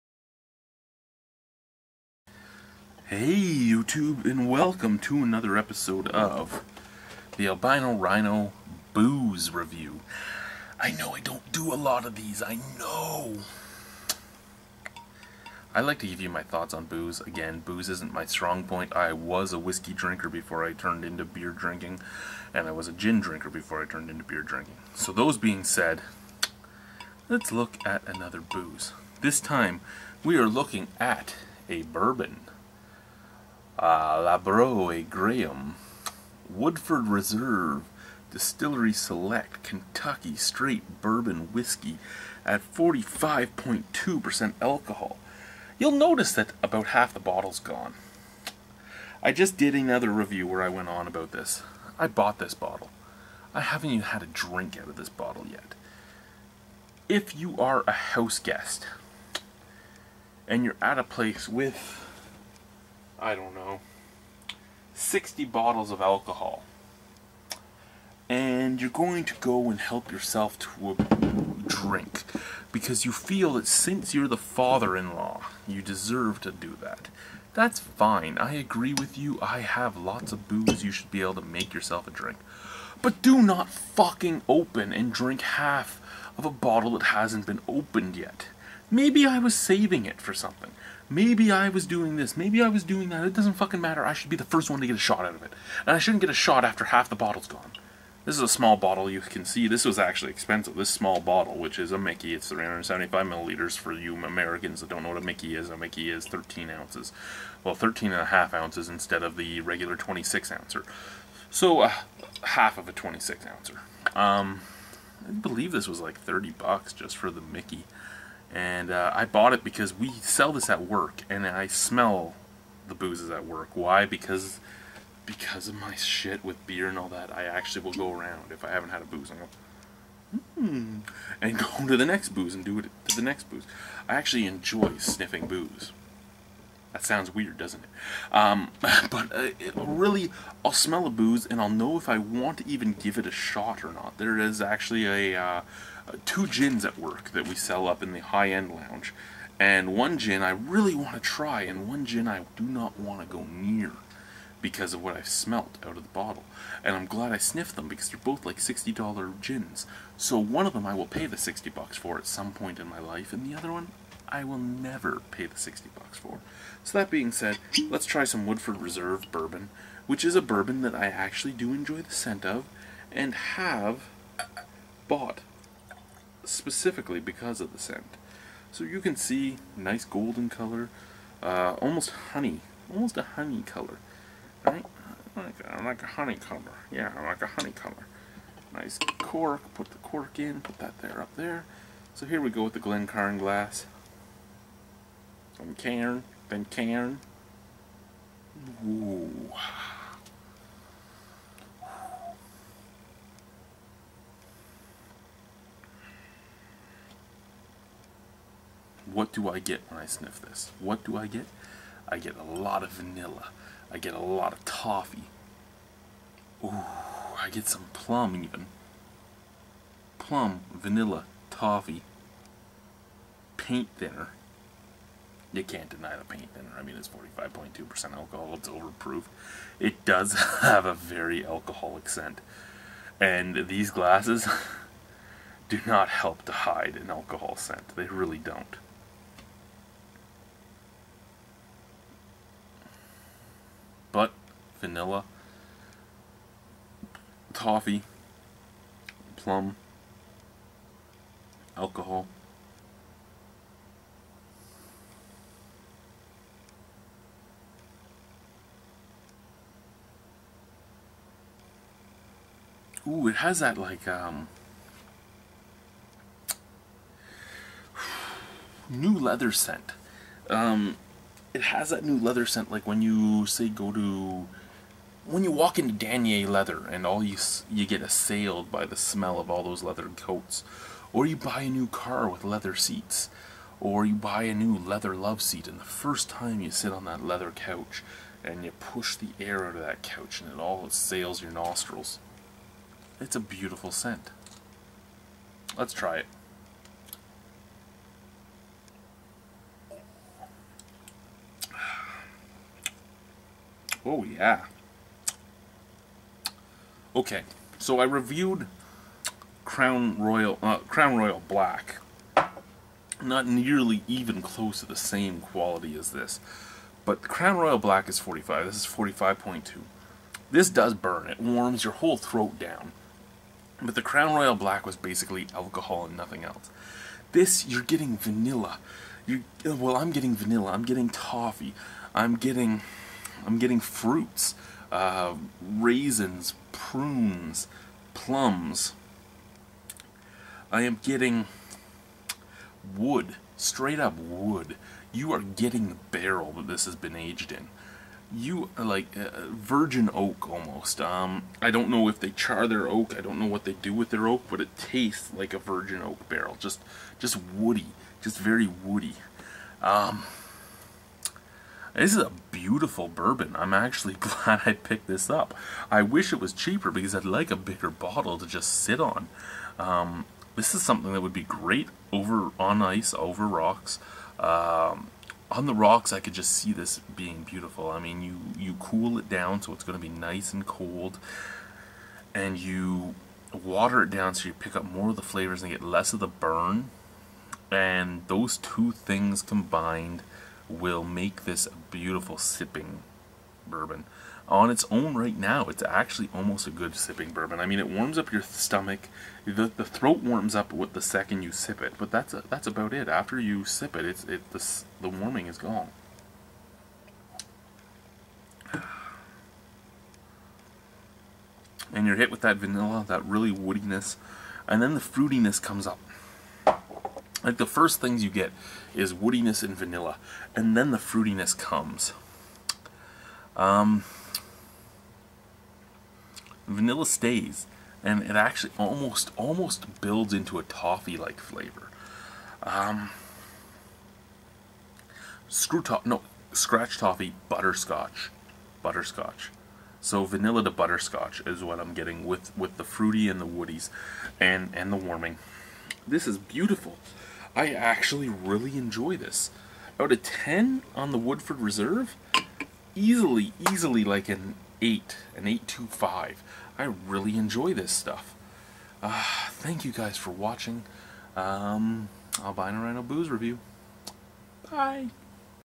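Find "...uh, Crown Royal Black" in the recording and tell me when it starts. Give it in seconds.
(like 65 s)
310 s.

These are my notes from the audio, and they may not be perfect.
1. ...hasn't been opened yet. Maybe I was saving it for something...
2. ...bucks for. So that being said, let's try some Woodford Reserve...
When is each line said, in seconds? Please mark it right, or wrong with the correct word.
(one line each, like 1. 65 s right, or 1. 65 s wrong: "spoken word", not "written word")
1. 87 s right
2. 165 s right.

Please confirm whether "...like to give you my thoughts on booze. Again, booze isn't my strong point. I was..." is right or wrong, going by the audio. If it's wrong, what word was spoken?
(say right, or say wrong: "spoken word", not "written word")
right.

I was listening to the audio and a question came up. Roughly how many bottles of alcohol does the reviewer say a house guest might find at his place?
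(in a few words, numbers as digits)
60.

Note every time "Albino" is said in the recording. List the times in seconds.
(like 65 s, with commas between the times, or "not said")
7 s, 462 s.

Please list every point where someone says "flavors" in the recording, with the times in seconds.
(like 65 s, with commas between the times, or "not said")
385 s, 431 s.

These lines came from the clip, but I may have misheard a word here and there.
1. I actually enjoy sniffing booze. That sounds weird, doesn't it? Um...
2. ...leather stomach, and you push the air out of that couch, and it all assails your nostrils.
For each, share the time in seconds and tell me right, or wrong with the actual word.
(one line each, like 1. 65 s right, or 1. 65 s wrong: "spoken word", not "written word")
1. 134 s right
2. 287 s wrong: "couch", not "stomach".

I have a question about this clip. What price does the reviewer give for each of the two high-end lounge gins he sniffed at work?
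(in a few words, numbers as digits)
$60.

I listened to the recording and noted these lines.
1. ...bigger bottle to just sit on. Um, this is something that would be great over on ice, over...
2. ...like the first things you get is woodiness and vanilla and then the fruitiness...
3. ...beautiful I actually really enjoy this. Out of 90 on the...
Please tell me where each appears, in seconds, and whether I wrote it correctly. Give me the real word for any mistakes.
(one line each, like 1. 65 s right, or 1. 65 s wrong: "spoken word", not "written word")
1. 367 s right
2. 417 s right
3. 446 s wrong: "10", not "90".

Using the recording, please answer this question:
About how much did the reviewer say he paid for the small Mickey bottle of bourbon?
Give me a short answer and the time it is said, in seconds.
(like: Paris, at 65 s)
30 bucks, at 116 s.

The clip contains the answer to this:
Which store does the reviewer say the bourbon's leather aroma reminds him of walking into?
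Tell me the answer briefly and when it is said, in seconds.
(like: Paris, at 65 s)
Danier Leather, at 275 s.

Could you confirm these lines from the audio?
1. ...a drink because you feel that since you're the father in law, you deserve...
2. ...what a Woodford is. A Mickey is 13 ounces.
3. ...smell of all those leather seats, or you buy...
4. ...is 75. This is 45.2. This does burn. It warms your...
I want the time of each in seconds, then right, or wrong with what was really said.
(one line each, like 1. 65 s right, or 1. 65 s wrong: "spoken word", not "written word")
1. 70 s right
2. 105 s wrong: "Mickey", not "Woodford"
3. 278 s wrong: "coats", not "seats"
4. 318 s wrong: "45", not "75".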